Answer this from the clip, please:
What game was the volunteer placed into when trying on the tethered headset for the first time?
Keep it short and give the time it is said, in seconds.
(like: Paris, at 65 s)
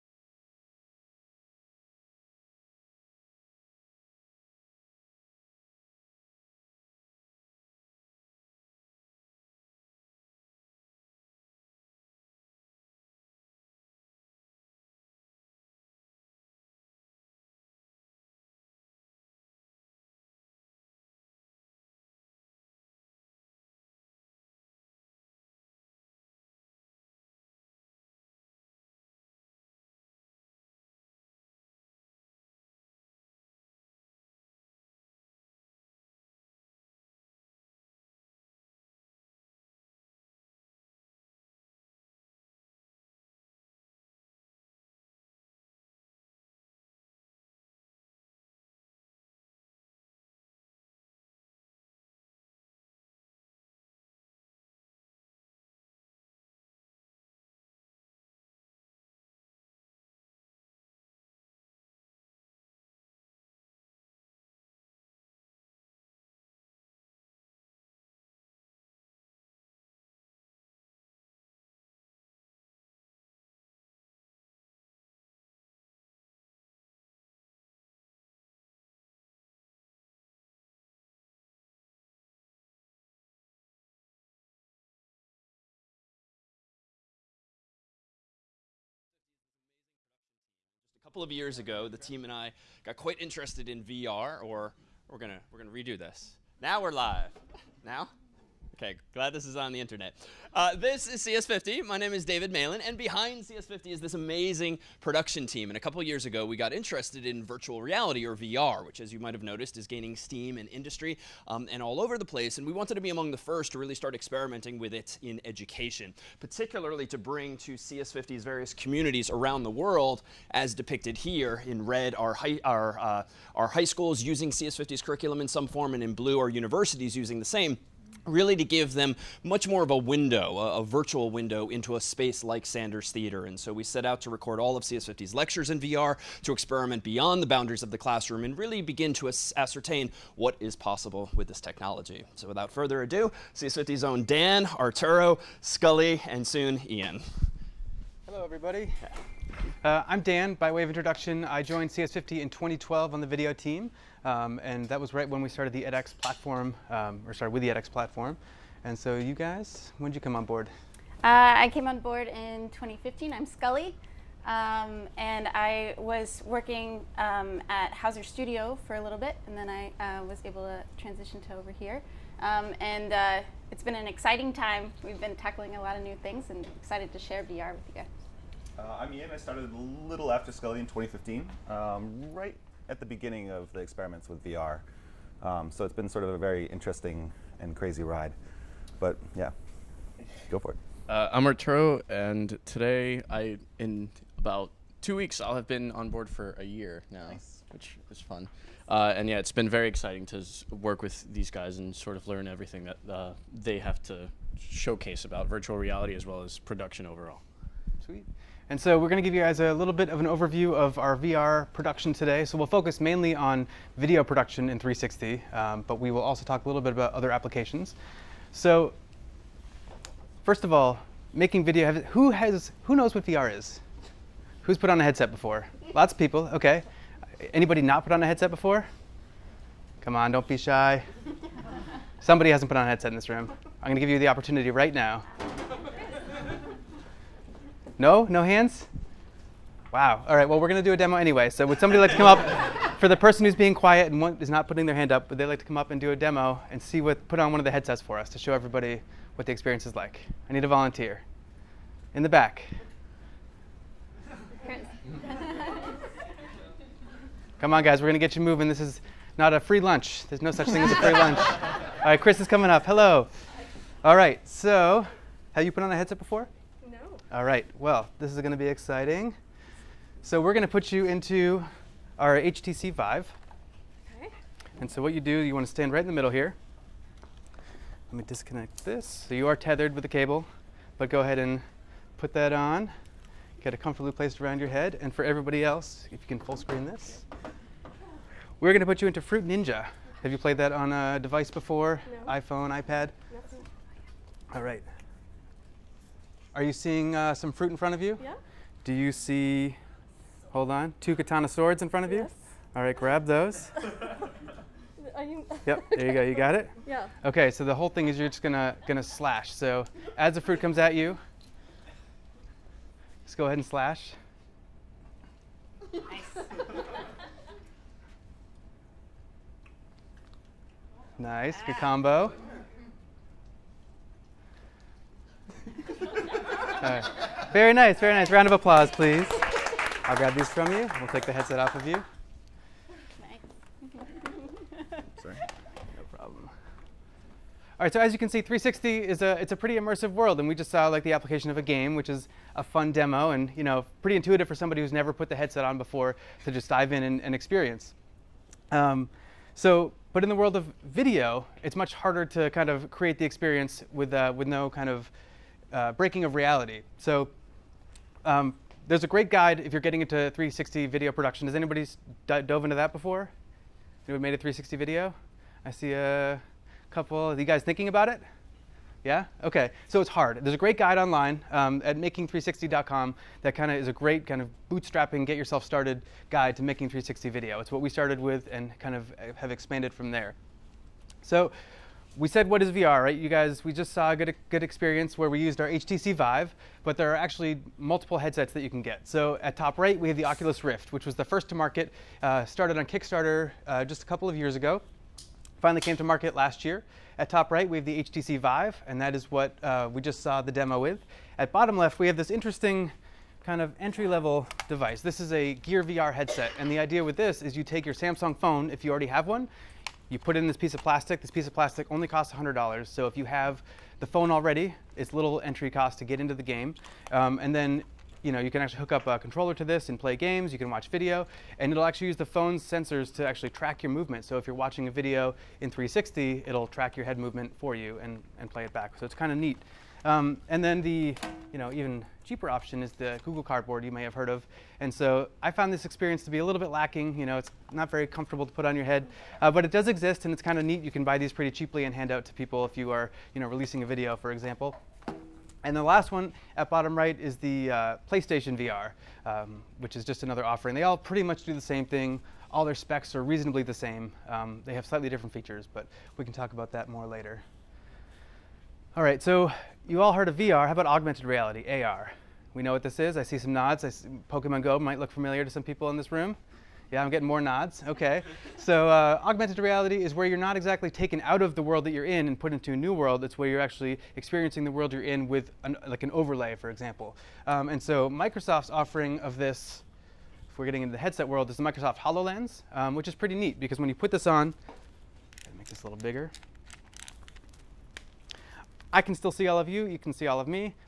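Fruit Ninja, at 289 s.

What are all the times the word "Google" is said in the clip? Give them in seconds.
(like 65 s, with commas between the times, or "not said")
433 s.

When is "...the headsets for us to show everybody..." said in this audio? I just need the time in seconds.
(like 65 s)
247 s.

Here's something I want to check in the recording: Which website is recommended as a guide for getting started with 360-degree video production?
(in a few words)
making360.com.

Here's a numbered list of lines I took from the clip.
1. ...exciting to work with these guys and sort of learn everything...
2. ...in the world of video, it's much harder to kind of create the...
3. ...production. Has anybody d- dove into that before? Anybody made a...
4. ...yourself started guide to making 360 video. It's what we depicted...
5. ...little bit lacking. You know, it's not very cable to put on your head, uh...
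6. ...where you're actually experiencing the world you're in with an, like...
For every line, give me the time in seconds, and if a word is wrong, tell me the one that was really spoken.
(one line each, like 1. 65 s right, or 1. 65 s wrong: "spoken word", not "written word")
1. 199 s right
2. 350 s right
3. 361 s right
4. 375 s wrong: "started", not "depicted"
5. 436 s wrong: "comfortable", not "cable"
6. 473 s right.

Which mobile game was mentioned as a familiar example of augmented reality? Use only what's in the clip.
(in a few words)
Pokemon Go.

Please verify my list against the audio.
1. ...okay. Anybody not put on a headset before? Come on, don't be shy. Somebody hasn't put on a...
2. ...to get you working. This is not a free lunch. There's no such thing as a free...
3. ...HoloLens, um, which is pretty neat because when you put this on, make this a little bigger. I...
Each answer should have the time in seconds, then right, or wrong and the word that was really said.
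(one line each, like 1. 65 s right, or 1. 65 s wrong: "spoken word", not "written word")
1. 226 s right
2. 258 s wrong: "moving", not "working"
3. 481 s right.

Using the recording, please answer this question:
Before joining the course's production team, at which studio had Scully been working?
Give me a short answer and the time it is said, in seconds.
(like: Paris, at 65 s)
Hauser Studio, at 167 s.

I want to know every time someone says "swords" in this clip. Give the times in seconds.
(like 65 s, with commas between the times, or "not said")
301 s.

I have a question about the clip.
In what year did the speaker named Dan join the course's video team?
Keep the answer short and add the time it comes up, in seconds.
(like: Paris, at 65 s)
2012, at 152 s.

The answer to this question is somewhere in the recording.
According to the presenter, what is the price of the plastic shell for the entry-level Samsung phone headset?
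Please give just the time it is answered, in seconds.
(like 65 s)
412 s.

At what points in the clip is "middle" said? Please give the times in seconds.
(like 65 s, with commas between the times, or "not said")
276 s.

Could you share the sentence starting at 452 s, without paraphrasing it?
All their specs are reasonably the same.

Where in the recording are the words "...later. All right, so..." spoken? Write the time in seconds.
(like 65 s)
457 s.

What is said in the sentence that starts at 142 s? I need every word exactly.
So without further ado, CS50's own Dan, Arturo, Scully, and soon Ian.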